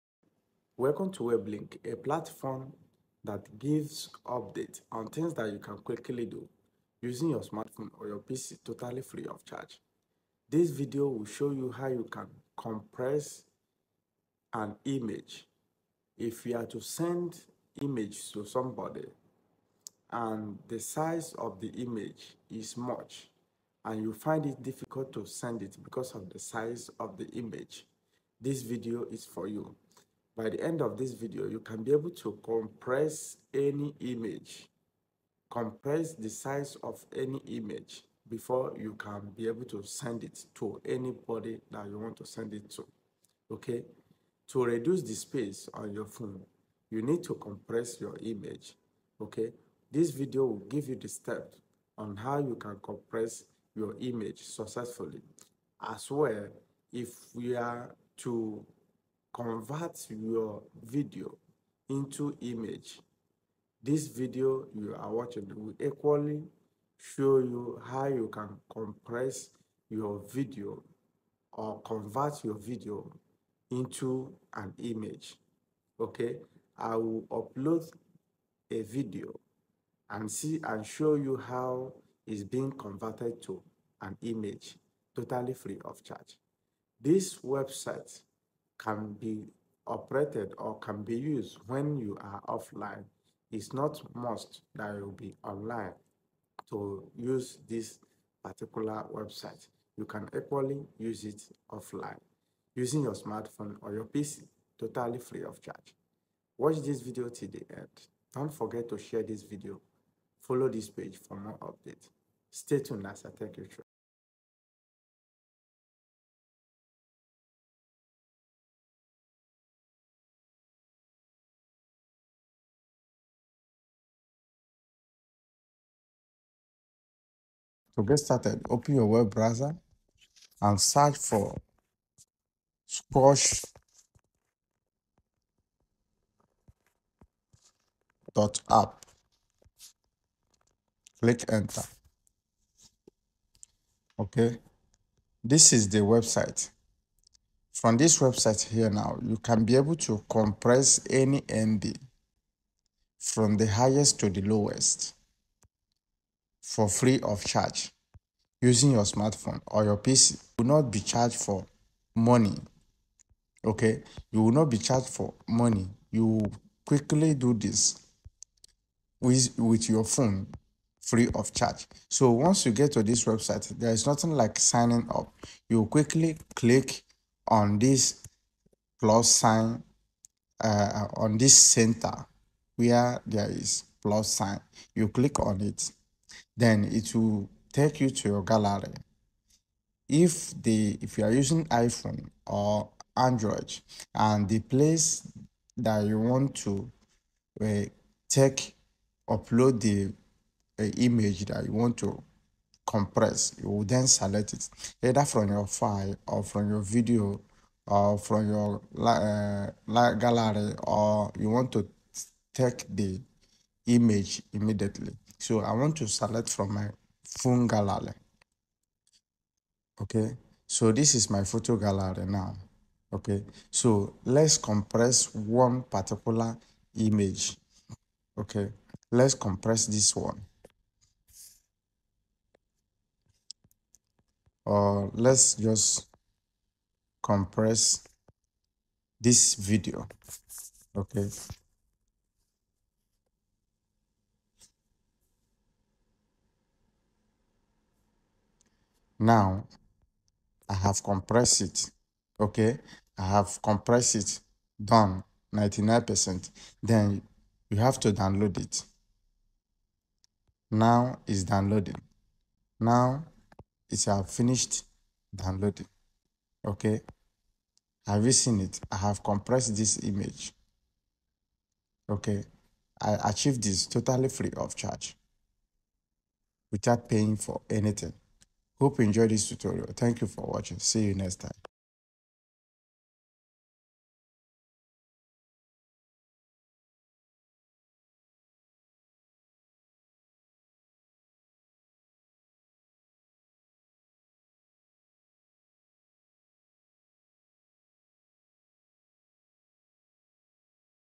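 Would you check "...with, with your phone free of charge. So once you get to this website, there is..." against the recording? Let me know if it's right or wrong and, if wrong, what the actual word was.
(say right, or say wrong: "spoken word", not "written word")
right.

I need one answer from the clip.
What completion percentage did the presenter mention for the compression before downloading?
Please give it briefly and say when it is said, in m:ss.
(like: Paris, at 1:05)
99%, at 4:15.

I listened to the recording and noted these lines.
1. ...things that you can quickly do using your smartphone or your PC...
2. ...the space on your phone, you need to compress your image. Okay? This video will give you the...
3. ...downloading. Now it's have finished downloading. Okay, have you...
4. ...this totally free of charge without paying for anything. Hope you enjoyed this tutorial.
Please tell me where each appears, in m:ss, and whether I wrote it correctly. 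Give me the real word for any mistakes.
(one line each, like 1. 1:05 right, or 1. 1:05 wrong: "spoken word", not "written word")
1. 0:05 right
2. 0:45 right
3. 4:21 right
4. 4:33 right.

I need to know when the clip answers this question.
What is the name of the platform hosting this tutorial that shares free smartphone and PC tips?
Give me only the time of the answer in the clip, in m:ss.
0:01.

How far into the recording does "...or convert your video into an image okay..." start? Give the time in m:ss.
1:11.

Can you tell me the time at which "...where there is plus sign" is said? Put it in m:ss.
3:02.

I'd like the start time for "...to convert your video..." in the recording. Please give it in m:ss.
0:58.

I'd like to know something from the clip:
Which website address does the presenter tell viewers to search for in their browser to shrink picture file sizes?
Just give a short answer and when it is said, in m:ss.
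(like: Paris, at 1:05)
squoosh.app, at 2:12.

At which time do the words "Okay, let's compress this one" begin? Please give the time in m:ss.
3:48.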